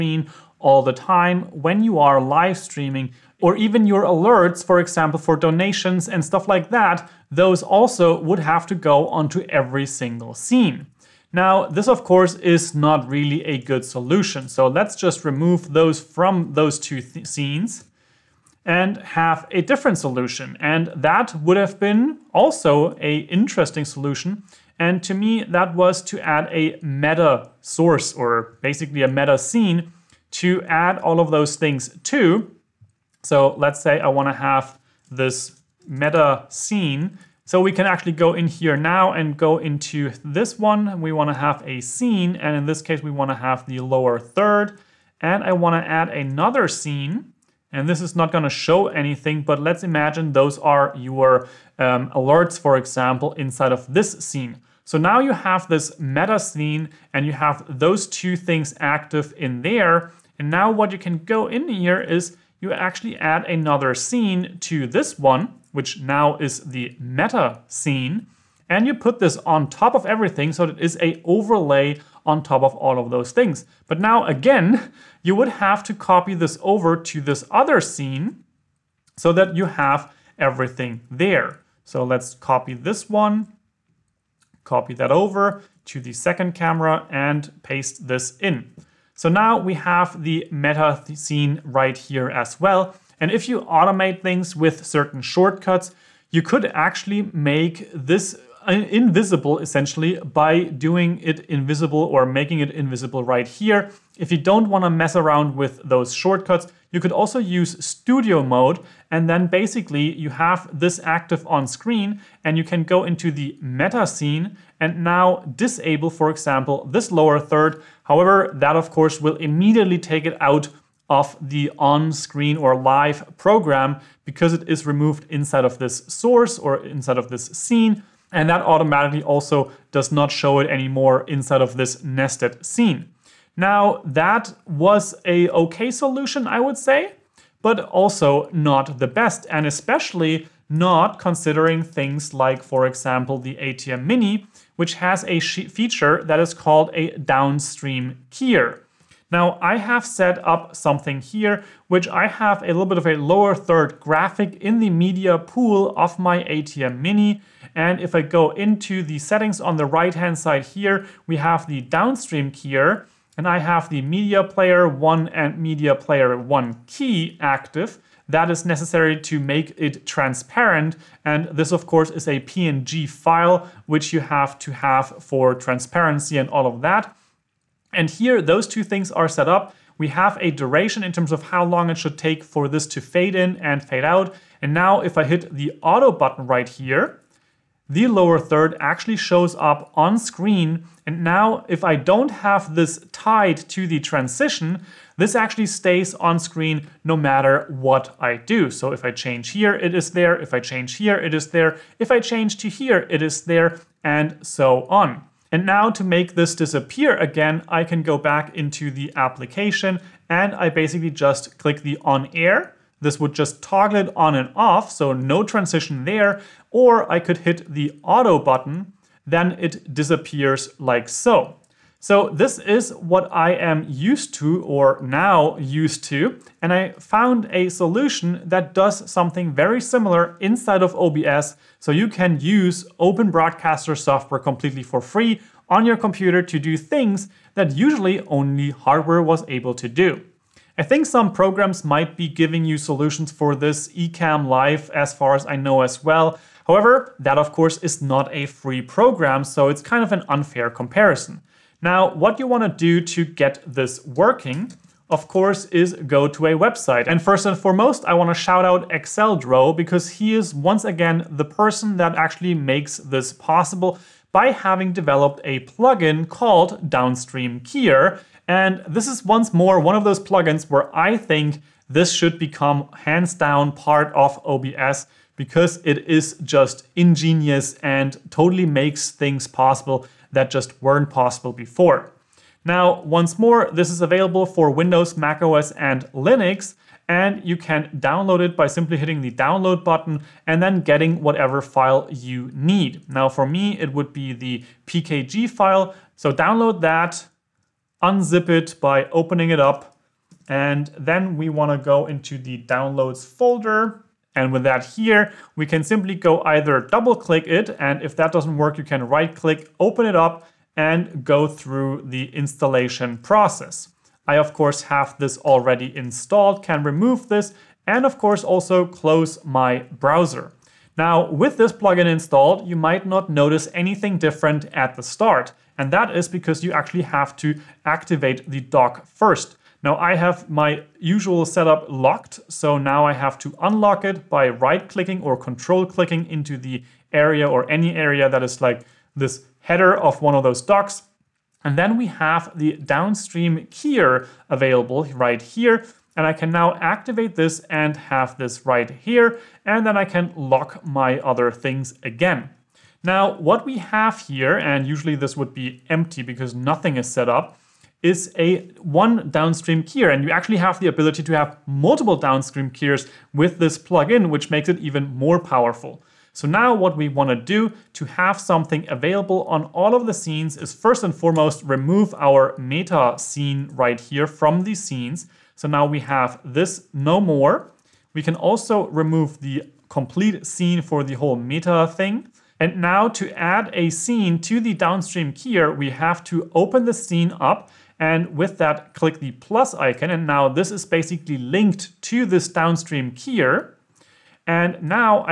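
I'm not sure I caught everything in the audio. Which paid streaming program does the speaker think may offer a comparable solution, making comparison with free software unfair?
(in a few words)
eCam Live.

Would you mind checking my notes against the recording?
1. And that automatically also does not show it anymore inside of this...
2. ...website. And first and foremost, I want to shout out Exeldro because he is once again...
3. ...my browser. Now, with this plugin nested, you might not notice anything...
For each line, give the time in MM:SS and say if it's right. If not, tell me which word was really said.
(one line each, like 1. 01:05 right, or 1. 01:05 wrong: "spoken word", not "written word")
1. 02:08 right
2. 04:16 right
3. 05:19 wrong: "installed", not "nested".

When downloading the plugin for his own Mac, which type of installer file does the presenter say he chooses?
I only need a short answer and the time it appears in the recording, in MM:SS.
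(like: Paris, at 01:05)
PKG file, at 04:54.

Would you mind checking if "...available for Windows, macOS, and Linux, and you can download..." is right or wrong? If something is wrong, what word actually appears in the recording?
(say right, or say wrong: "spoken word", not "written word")
right.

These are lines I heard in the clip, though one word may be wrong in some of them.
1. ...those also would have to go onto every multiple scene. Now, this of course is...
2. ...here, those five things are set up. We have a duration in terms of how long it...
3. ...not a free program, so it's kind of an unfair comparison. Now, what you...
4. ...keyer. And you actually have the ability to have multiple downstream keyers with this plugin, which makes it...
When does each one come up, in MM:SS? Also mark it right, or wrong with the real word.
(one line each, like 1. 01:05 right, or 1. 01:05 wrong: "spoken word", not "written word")
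1. 00:07 wrong: "single", not "multiple"
2. 02:58 wrong: "two", not "five"
3. 04:08 right
4. 05:59 right.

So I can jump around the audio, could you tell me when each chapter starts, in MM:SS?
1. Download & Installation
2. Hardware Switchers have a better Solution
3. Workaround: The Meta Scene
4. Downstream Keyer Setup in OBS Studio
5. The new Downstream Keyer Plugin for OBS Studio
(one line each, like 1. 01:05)
1. 04:10
2. 02:16
3. 00:17
4. 05:19
5. 03:40.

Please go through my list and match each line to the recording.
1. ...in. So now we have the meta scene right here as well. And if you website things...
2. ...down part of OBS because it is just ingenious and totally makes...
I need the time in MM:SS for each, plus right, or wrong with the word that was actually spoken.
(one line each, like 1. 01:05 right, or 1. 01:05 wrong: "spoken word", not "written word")
1. 01:28 wrong: "automate", not "website"
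2. 04:33 right.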